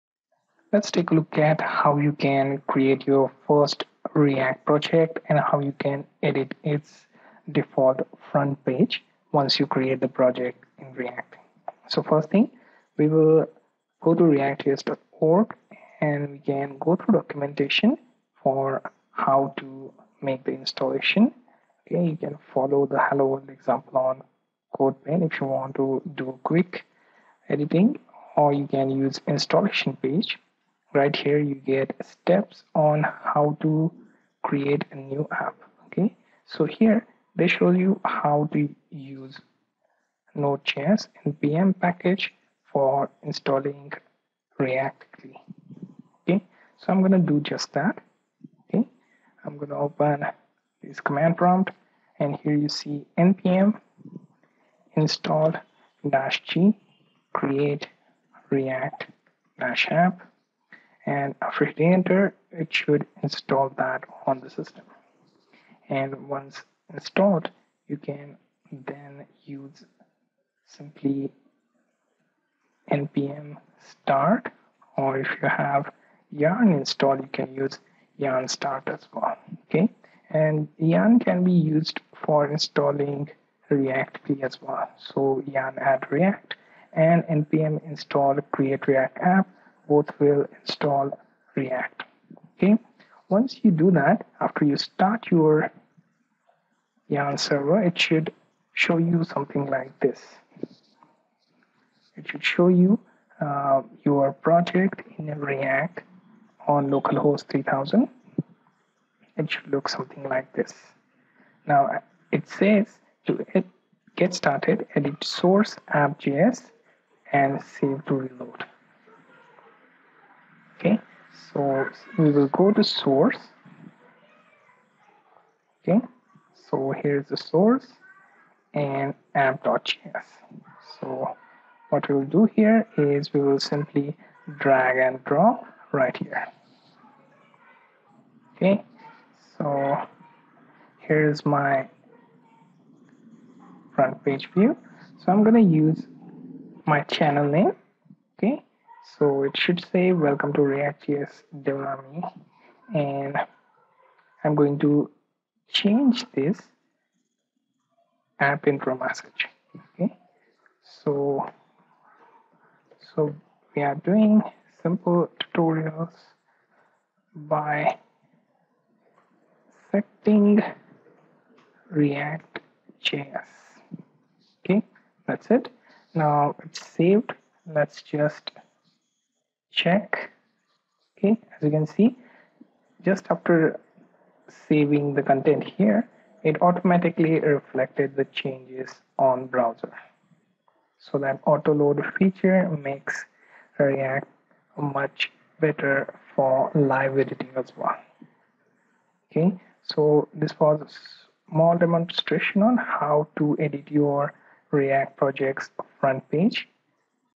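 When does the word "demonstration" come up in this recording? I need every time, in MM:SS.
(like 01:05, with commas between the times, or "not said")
03:21.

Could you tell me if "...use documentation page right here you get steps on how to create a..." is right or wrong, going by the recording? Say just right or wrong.
wrong.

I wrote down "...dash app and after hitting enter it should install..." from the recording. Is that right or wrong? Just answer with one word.
right.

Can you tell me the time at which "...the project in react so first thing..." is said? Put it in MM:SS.
00:09.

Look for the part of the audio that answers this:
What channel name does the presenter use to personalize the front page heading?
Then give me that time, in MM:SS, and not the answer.
02:31.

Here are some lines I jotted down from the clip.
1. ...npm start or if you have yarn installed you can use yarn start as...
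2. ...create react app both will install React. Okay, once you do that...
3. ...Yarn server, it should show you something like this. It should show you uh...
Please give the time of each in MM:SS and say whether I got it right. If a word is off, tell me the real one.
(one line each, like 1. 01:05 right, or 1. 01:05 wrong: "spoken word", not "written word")
1. 01:12 right
2. 01:28 right
3. 01:37 right.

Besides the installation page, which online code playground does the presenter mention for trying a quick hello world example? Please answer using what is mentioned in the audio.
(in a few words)
CodePen.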